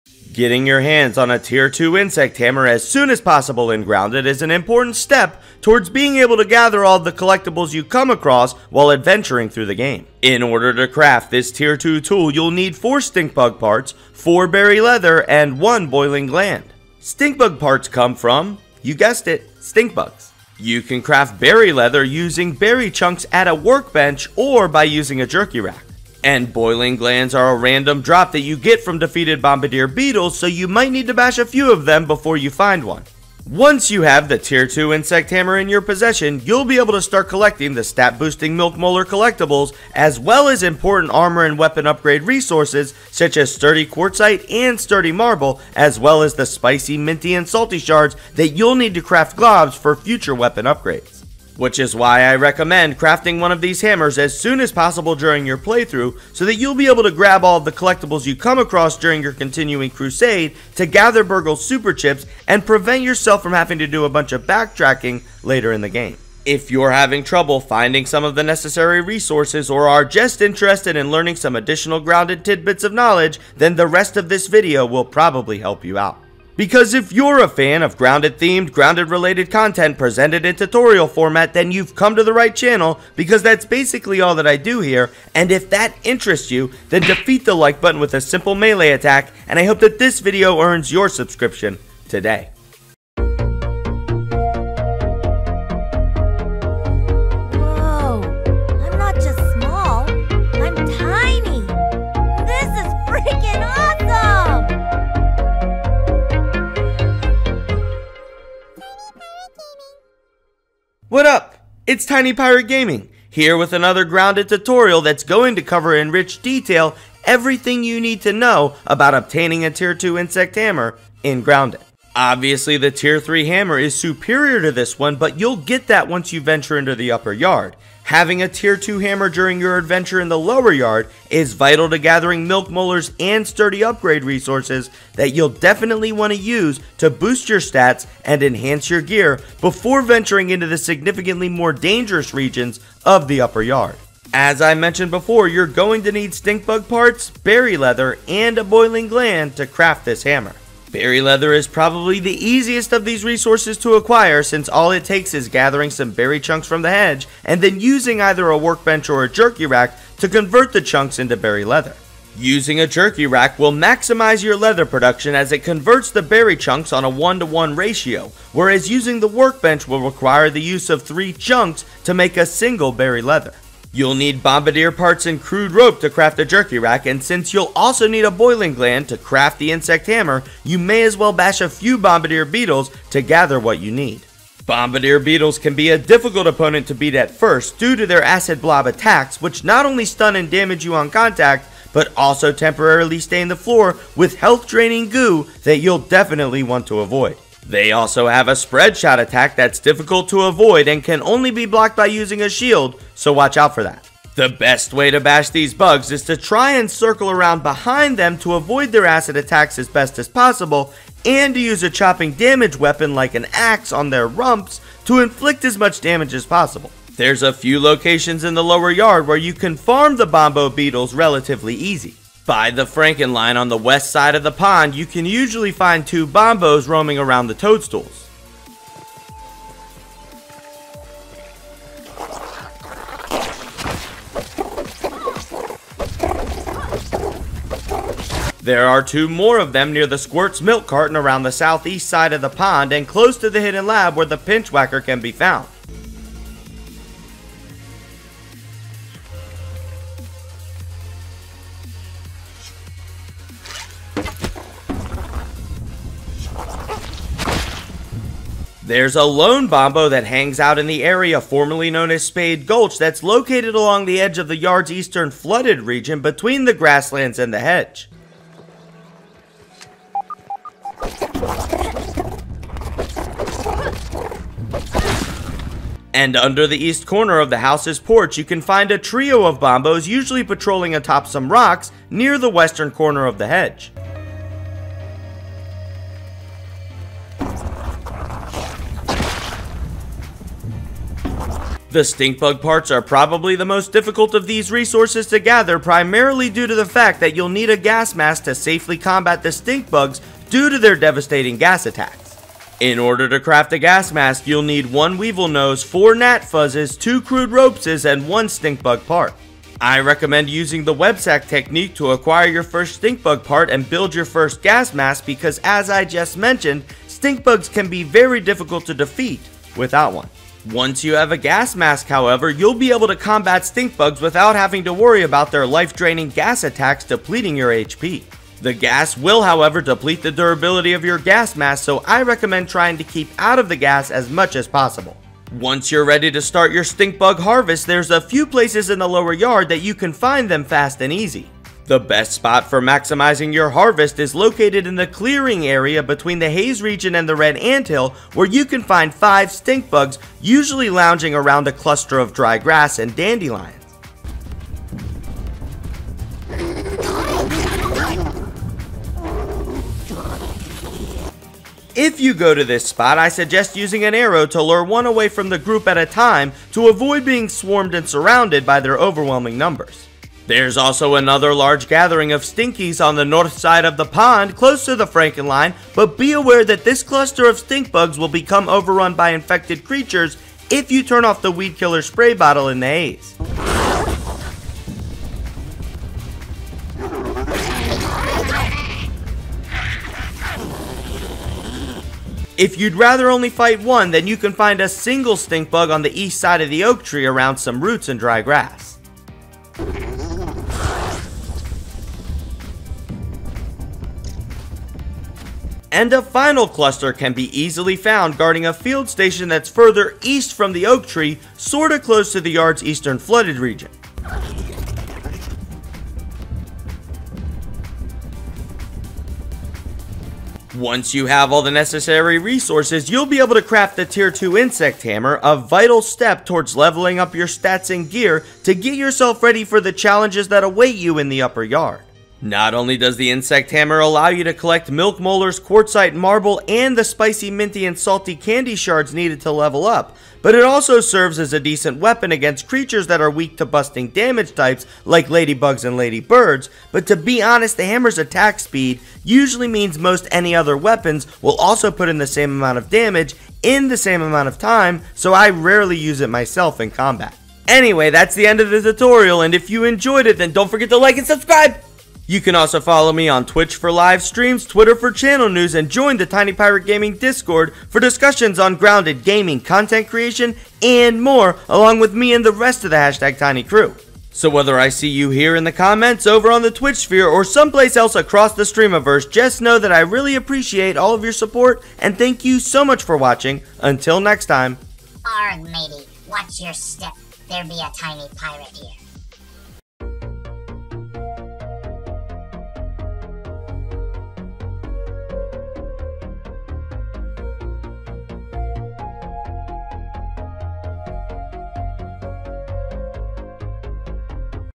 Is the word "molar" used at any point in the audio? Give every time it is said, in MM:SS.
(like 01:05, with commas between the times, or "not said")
00:38, 02:12, 07:15.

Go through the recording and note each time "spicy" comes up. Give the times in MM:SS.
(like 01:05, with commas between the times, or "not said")
00:46, 07:17.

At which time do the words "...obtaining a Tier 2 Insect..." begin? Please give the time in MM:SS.
01:59.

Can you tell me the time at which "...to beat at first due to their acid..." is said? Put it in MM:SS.
03:06.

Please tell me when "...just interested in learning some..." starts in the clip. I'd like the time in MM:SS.
01:10.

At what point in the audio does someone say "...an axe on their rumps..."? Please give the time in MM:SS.
03:33.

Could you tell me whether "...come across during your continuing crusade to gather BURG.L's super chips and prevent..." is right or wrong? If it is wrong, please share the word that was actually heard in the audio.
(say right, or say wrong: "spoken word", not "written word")
right.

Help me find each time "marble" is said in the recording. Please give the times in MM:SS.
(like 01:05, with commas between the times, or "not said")
00:45, 07:16.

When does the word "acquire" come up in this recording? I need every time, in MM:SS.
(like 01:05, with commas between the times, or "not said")
02:33, 05:12.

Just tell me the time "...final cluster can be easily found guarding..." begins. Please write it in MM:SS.
06:46.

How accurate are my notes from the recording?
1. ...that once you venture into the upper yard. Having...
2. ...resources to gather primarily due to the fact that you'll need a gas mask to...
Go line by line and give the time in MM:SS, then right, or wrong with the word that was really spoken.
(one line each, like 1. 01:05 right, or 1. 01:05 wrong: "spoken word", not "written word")
1. 02:05 right
2. 04:54 right.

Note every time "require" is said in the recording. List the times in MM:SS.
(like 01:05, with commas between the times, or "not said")
02:50.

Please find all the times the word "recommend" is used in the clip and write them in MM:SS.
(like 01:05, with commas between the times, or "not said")
00:52, 05:09, 05:32.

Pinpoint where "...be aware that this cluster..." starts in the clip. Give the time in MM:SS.
06:16.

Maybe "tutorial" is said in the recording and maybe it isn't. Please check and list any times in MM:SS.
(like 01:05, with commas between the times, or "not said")
01:20, 01:54, 07:38.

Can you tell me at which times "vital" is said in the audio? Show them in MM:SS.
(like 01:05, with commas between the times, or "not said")
02:11, 07:05.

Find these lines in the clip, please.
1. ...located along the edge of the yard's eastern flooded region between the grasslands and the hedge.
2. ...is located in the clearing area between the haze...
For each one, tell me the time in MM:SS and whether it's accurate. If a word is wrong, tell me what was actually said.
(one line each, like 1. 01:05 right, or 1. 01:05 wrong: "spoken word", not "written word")
1. 04:23 right
2. 05:44 right.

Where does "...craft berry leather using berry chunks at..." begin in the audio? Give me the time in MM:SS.
00:21.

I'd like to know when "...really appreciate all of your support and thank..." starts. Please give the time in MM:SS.
07:59.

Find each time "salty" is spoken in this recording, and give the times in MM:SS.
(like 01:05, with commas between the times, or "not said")
00:47, 07:17.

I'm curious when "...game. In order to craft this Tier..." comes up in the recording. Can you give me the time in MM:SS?
00:09.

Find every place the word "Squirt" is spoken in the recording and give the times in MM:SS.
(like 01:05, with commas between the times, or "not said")
04:00.